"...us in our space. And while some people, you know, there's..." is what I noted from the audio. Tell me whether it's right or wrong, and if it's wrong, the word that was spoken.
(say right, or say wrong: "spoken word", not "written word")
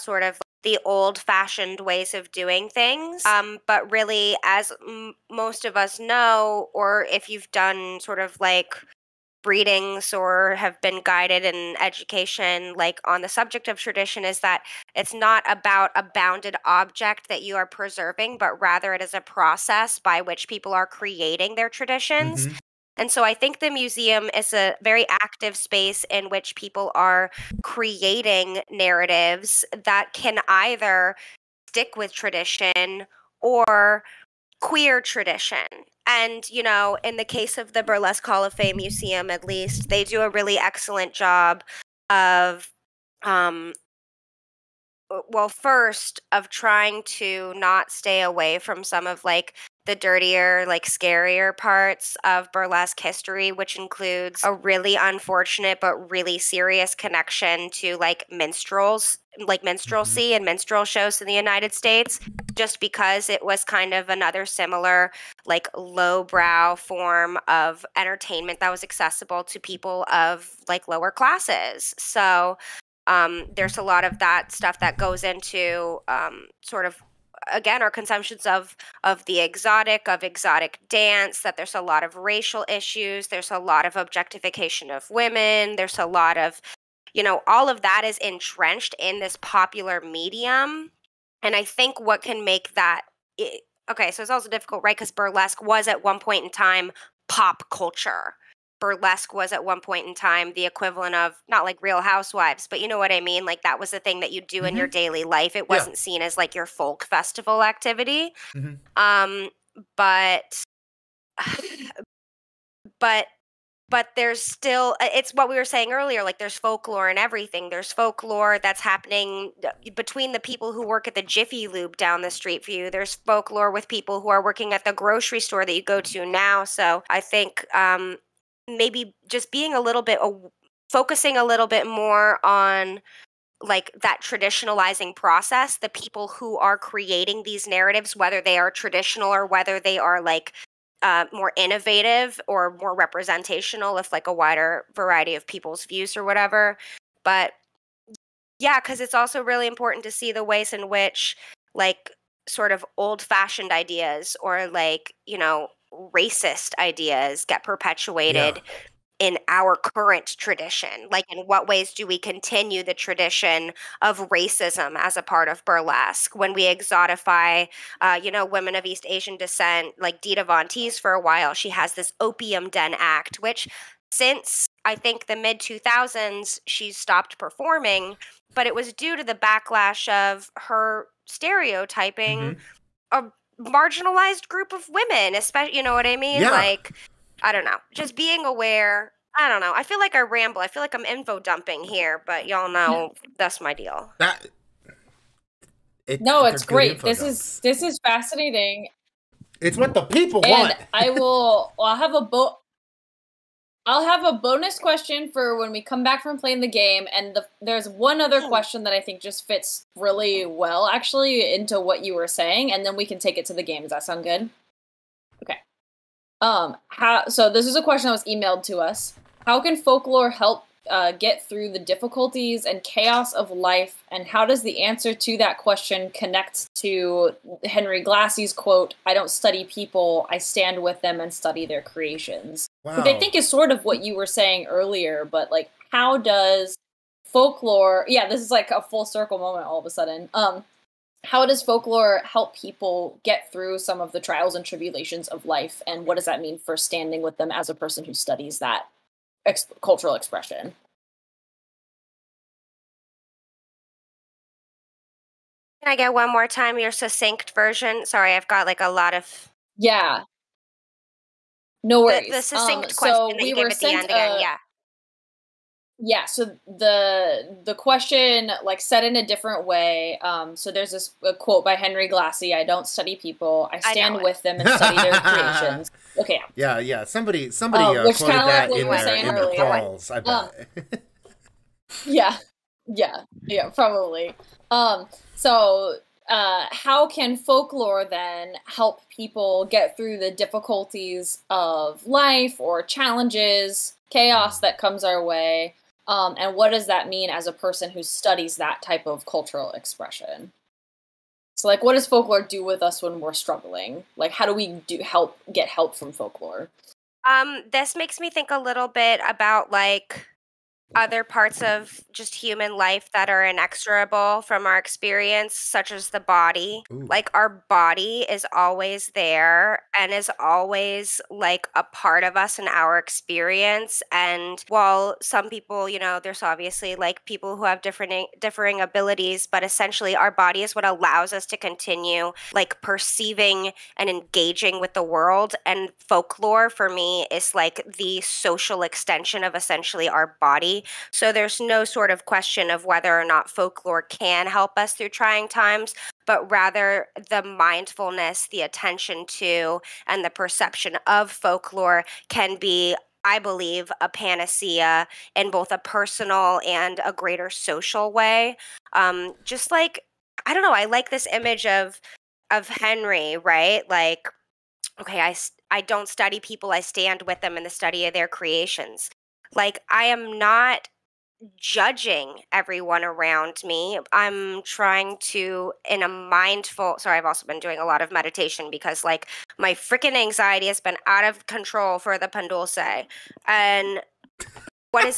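wrong: "experience", not "space".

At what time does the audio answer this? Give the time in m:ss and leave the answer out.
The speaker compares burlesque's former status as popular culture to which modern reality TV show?
1:41.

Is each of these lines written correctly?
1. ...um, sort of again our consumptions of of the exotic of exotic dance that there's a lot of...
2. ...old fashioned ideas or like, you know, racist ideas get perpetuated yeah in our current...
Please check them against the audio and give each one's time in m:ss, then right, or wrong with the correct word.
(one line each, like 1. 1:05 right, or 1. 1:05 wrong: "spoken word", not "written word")
1. 1:16 right
2. 2:32 right.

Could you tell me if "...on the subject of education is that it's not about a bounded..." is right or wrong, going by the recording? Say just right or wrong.
wrong.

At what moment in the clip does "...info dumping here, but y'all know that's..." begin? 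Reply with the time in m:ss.
3:11.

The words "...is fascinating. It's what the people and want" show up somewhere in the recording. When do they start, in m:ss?
3:17.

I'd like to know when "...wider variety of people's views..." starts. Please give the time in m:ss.
2:24.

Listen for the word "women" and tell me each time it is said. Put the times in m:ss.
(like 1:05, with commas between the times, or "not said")
1:25, 2:48, 3:04.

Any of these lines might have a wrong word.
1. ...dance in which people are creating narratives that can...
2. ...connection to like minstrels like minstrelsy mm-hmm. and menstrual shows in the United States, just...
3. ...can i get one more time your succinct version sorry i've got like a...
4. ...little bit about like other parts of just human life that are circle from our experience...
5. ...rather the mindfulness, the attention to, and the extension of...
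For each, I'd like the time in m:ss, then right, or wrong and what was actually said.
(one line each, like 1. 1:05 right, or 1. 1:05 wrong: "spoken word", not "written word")
1. 0:25 wrong: "space", not "dance"
2. 0:56 right
3. 4:15 right
4. 5:08 wrong: "inexorable", not "circle"
5. 5:46 wrong: "perception", not "extension".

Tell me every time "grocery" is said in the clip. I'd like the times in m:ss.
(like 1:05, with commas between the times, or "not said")
2:04.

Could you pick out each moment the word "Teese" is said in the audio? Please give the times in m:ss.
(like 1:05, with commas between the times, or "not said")
2:50.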